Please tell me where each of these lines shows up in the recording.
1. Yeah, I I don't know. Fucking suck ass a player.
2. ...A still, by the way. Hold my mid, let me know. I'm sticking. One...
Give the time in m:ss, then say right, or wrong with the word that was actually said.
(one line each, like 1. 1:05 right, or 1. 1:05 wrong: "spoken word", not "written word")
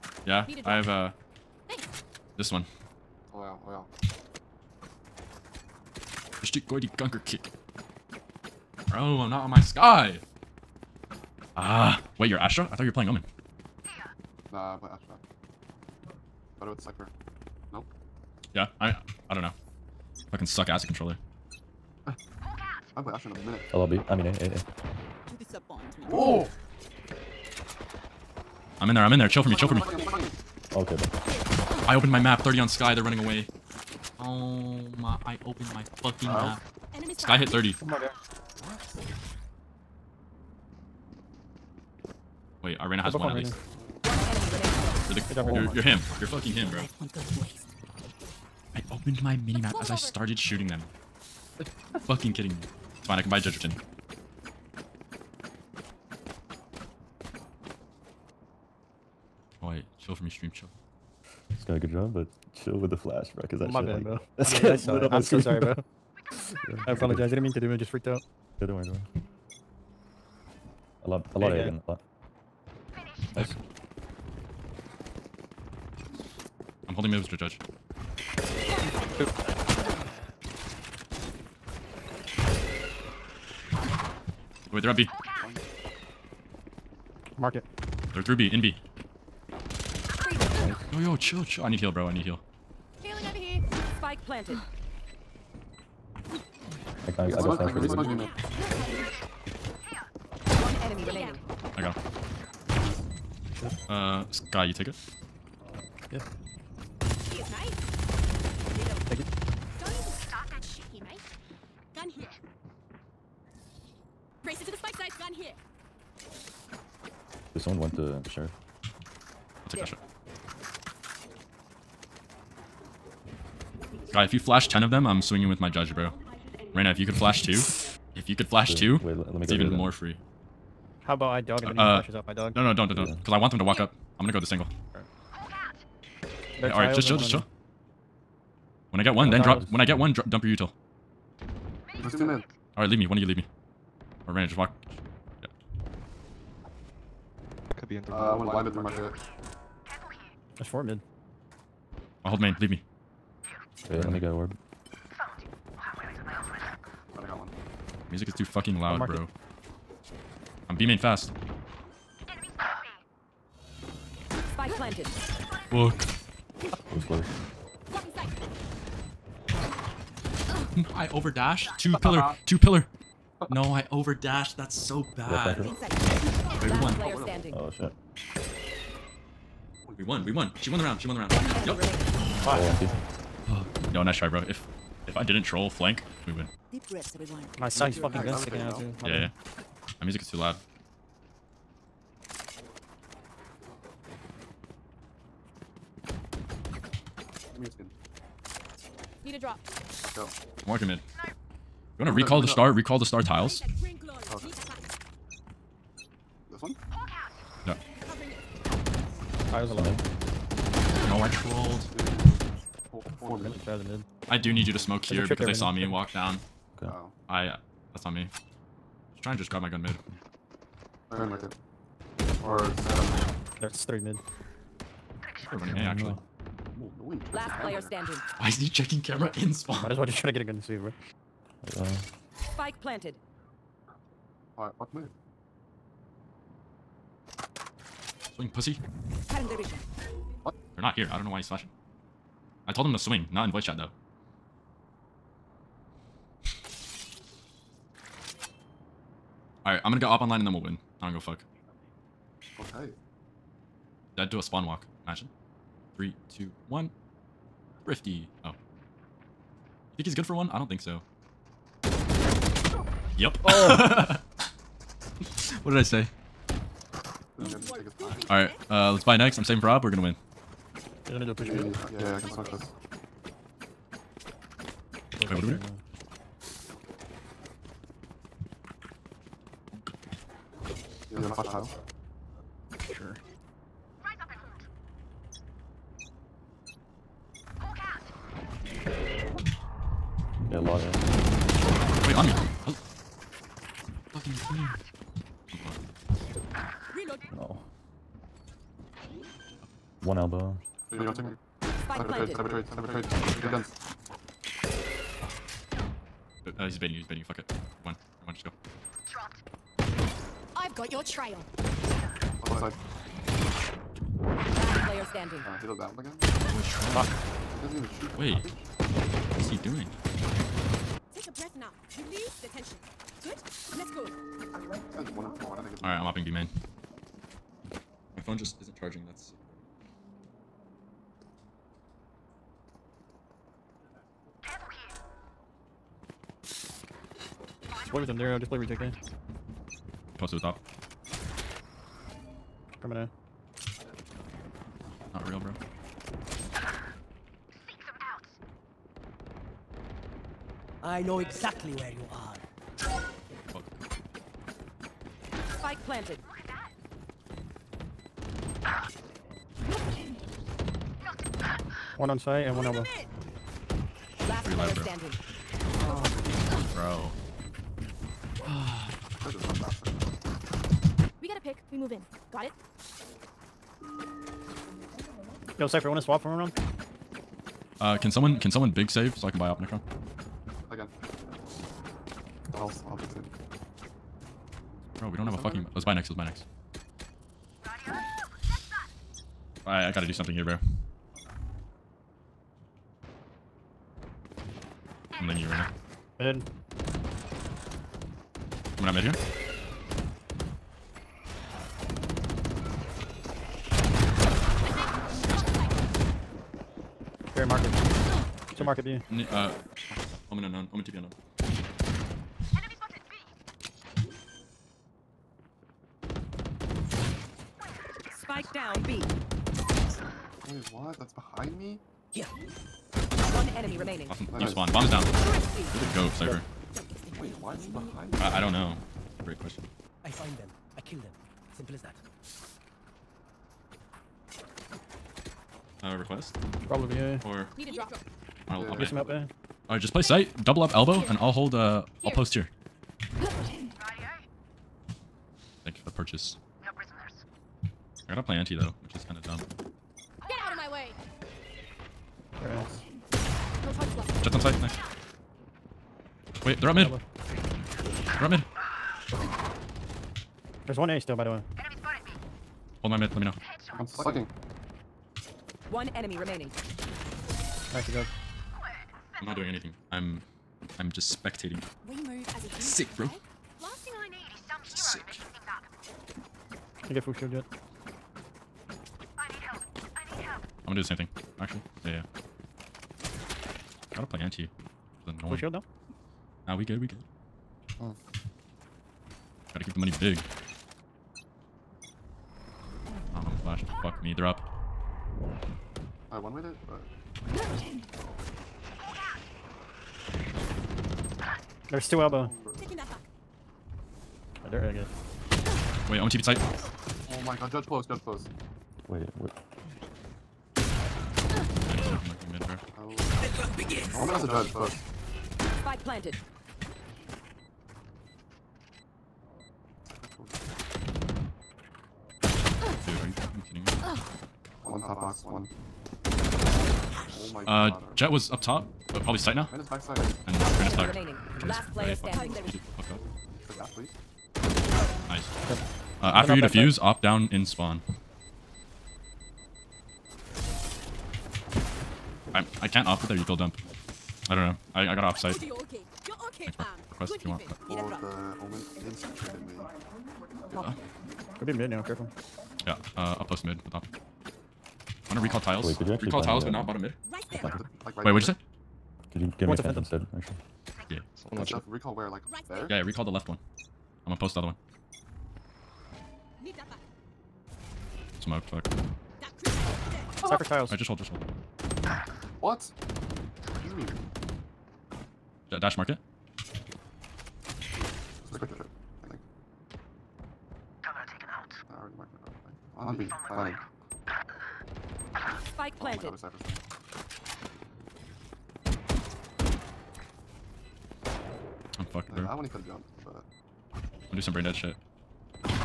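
1. 0:18 wrong: "controller", not "player"
2. 7:40 wrong: "fucking", not "sticking".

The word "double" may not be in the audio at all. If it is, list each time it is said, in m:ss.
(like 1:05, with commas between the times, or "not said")
7:20.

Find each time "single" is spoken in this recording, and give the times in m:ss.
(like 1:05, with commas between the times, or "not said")
2:14.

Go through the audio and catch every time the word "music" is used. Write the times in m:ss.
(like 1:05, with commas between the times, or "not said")
2:38, 3:10.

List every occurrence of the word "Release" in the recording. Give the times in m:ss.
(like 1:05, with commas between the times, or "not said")
5:21.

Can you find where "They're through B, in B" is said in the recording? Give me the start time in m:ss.
1:28.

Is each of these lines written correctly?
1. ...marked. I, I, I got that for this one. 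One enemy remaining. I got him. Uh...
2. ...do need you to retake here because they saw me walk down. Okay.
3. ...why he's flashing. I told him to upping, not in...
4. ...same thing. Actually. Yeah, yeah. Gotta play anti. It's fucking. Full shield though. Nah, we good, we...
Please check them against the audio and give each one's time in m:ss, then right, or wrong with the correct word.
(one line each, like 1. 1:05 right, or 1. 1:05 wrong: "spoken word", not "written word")
1. 1:34 wrong: "planted", not "marked"
2. 3:34 wrong: "smoke", not "retake"
3. 4:01 wrong: "swing", not "upping"
4. 8:00 wrong: "annoying", not "fucking".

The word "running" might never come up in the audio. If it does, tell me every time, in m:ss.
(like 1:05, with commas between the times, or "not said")
0:33, 3:45.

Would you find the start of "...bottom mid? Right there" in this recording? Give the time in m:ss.
9:16.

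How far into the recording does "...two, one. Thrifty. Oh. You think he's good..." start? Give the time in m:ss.
4:16.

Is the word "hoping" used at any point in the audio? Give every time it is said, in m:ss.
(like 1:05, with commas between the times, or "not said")
not said.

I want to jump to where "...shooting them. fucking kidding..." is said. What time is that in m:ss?
0:50.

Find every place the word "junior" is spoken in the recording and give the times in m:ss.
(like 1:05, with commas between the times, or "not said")
not said.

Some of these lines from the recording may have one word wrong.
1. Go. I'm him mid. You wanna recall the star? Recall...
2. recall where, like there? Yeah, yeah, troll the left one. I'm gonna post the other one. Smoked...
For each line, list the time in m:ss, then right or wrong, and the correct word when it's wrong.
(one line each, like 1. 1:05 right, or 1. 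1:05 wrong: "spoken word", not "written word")
1. 3:20 right
2. 9:21 wrong: "recall", not "troll".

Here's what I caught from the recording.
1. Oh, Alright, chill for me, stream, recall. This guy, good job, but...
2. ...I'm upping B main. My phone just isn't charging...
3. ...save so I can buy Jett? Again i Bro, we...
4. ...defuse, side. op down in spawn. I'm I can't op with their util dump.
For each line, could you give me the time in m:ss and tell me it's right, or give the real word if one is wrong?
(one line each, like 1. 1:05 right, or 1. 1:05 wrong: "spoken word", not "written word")
1. 0:59 wrong: "chill", not "recall"
2. 5:25 right
3. 6:18 wrong: "Opnicron", not "Jett"
4. 8:56 right.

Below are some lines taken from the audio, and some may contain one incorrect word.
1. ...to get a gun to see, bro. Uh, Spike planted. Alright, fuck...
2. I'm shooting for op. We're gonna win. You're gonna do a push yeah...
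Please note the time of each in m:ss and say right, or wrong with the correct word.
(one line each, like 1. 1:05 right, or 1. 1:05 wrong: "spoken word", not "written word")
1. 3:50 right
2. 4:29 wrong: "saving", not "shooting".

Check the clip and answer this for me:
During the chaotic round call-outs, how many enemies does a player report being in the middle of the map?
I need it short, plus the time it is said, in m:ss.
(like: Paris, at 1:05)
4, at 2:30.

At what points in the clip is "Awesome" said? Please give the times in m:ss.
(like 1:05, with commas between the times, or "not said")
7:04.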